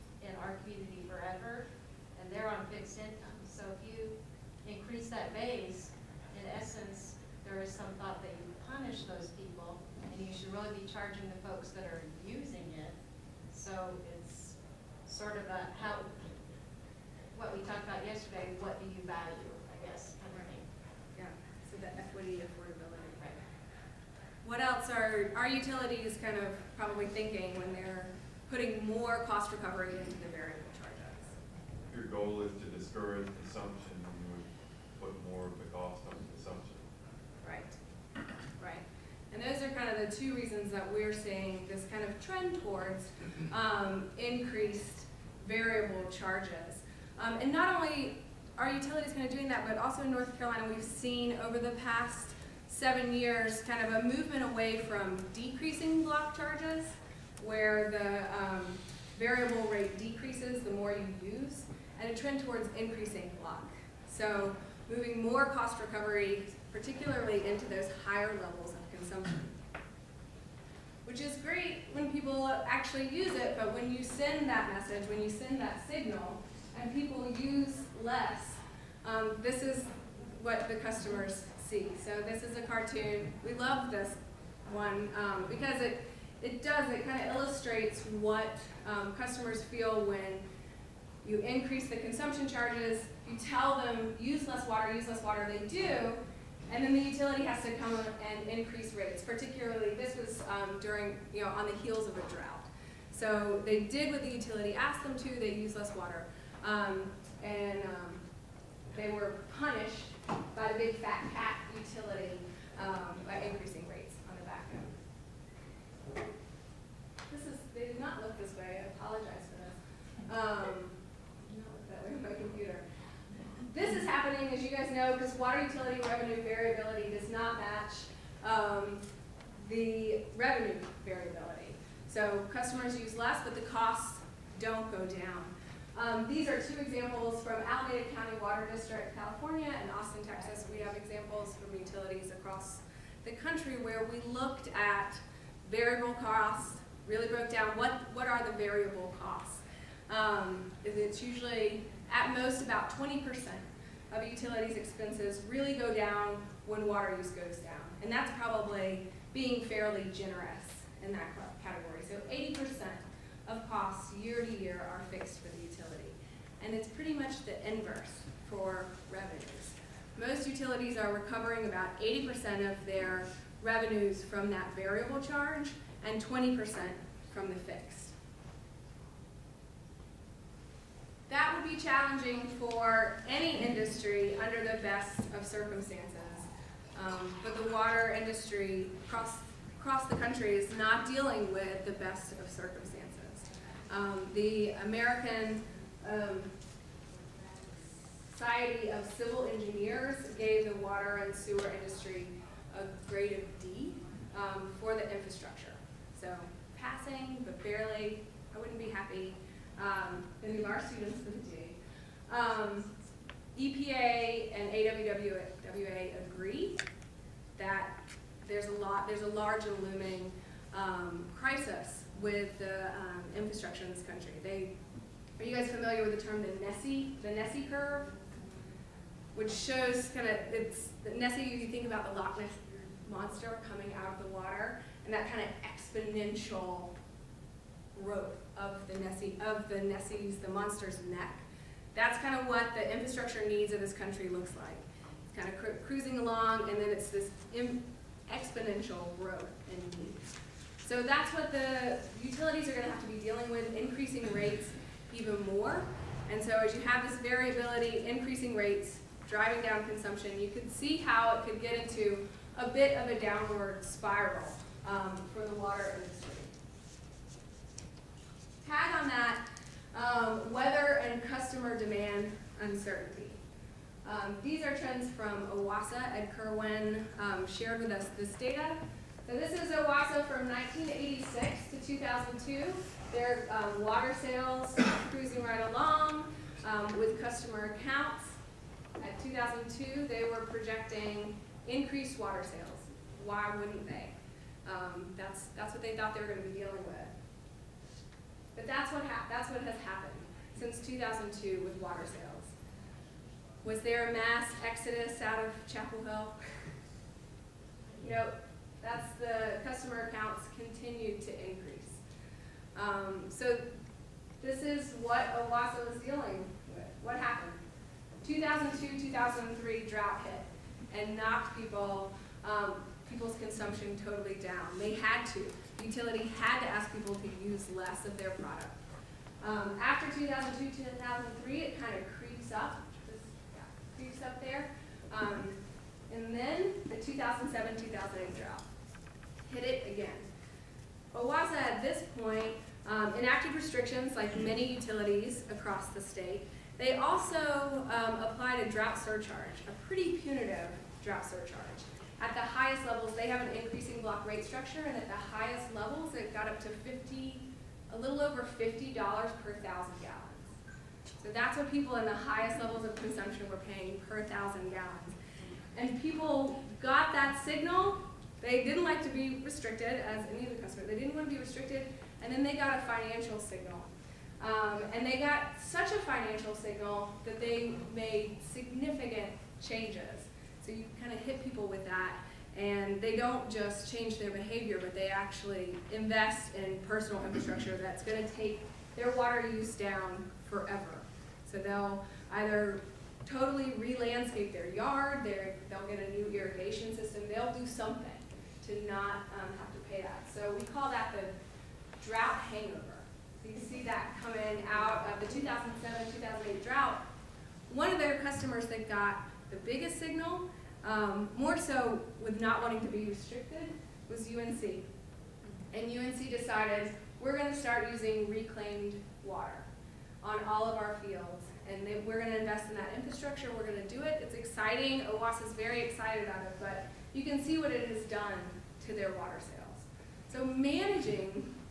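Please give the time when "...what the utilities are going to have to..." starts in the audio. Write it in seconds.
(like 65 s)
251 s.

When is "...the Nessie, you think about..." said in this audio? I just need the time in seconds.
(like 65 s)
231 s.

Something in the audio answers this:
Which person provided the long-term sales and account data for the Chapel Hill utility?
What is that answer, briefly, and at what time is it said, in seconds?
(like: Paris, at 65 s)
Ed Kerwin, at 276 s.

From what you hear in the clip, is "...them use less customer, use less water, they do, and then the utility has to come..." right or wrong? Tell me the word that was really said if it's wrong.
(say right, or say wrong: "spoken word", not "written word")
wrong: "water", not "customer".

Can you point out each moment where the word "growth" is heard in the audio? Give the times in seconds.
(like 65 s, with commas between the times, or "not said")
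238 s, 249 s.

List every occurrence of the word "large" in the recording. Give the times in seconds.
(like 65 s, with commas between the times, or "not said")
219 s.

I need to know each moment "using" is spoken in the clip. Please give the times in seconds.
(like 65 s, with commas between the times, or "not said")
12 s, 417 s.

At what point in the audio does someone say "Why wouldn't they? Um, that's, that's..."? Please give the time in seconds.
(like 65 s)
293 s.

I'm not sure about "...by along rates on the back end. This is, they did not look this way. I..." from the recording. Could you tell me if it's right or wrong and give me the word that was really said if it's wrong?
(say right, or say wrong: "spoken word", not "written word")
wrong: "increasing", not "along".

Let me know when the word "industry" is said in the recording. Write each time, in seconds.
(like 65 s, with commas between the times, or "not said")
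183 s, 188 s, 201 s, 265 s.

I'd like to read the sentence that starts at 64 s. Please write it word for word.
So moving more cost recovery, particularly into those higher levels of consumption.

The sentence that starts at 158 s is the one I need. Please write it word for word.
And that's probably being fairly generous in that category.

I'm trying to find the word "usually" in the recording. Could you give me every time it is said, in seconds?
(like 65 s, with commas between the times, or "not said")
151 s.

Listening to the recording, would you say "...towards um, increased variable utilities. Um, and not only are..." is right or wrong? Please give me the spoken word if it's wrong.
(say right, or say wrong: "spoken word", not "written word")
wrong: "charges", not "utilities".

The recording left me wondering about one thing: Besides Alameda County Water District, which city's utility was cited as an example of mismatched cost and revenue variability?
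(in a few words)
Austin, Texas.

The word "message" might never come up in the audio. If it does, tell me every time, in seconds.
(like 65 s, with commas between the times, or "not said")
74 s.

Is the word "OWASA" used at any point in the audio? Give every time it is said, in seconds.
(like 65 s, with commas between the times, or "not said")
275 s, 279 s, 315 s, 341 s, 425 s.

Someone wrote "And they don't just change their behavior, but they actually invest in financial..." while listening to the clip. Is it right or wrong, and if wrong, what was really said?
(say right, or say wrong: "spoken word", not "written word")
wrong: "personal", not "financial".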